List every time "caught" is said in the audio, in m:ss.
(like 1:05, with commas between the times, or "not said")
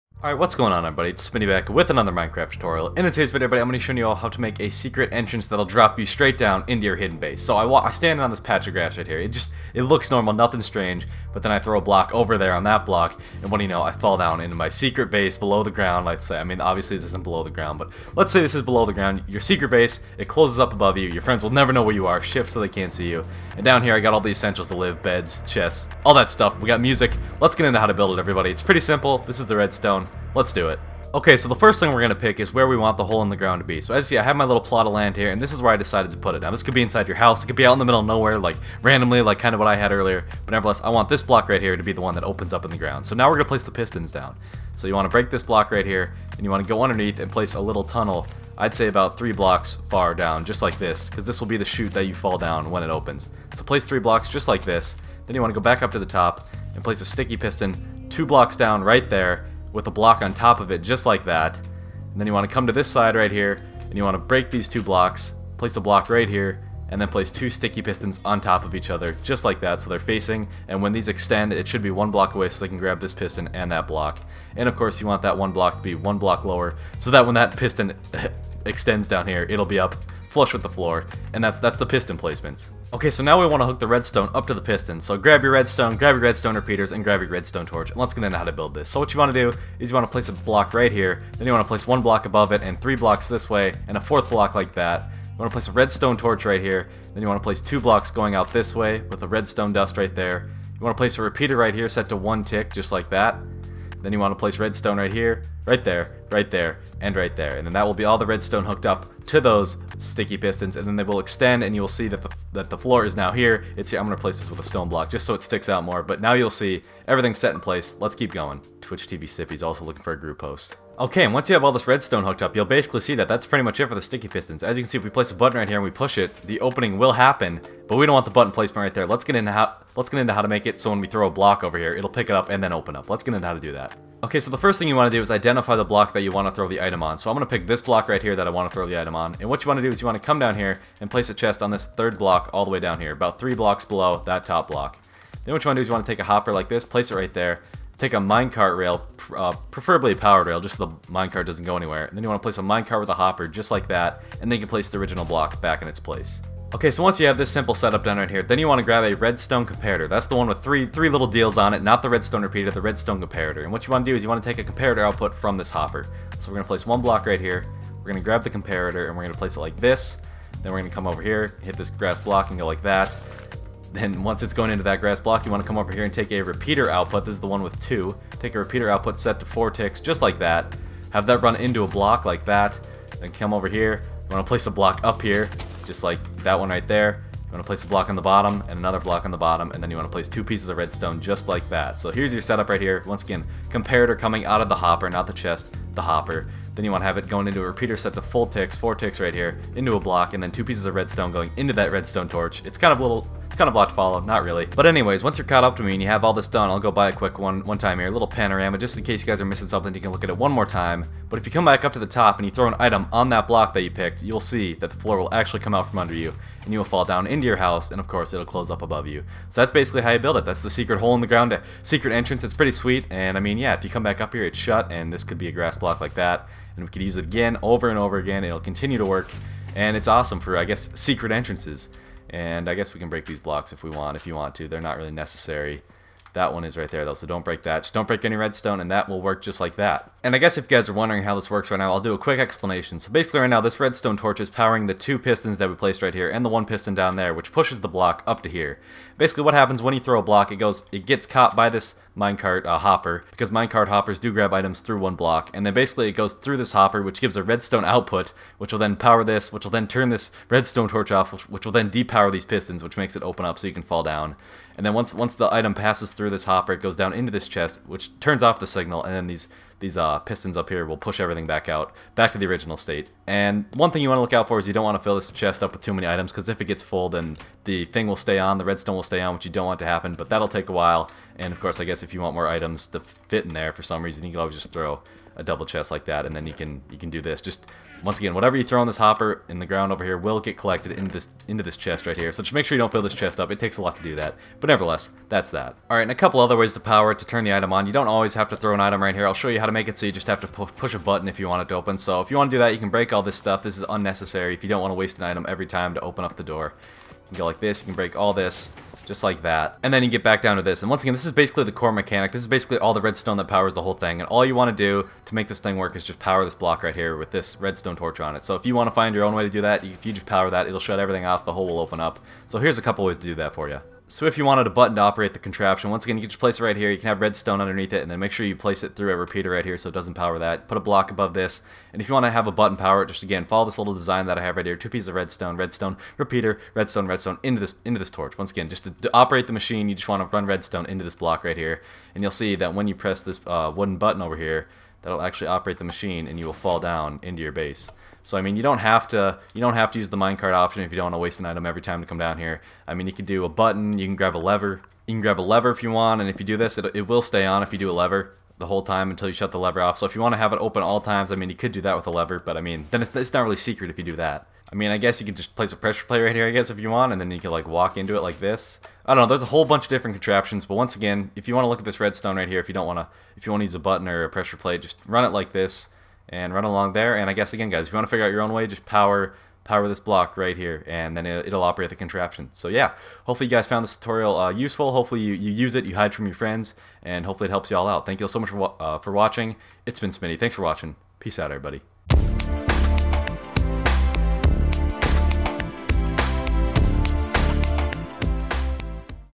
3:25, 4:11.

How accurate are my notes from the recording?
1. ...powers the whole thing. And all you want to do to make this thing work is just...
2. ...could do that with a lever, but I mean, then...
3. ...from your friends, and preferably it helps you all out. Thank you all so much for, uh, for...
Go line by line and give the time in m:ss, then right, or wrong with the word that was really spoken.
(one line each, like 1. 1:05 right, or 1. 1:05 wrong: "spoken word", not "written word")
1. 5:13 right
2. 6:01 right
3. 6:26 wrong: "hopefully", not "preferably".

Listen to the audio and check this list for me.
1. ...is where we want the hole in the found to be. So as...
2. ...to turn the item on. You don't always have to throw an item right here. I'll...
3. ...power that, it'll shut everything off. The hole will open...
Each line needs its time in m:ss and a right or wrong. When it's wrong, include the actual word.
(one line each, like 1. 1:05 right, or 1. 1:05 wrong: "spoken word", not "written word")
1. 0:32 wrong: "ground", not "found"
2. 4:57 right
3. 5:20 right.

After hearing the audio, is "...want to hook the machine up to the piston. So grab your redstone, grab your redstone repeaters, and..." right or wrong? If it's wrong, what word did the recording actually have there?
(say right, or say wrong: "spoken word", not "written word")
wrong: "redstone", not "machine".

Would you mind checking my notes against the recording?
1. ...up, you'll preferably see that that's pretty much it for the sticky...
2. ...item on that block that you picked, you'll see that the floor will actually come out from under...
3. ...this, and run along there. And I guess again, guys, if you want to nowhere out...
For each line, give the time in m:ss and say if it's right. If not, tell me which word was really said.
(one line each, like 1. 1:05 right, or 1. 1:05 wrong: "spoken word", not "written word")
1. 2:02 wrong: "basically", not "preferably"
2. 3:32 right
3. 6:15 wrong: "figure", not "nowhere".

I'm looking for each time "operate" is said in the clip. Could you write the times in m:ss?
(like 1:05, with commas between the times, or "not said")
5:25, 5:39, 5:45, 6:21.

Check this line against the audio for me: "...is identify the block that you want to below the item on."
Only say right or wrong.
wrong.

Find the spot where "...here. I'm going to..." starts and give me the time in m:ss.
1:53.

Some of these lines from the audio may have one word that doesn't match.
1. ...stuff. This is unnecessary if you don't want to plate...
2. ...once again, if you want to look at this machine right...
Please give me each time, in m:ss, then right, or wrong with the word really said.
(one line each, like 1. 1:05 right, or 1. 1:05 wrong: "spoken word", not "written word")
1. 5:03 wrong: "waste", not "plate"
2. 6:10 wrong: "redstone", not "machine".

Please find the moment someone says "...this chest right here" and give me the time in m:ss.
4:51.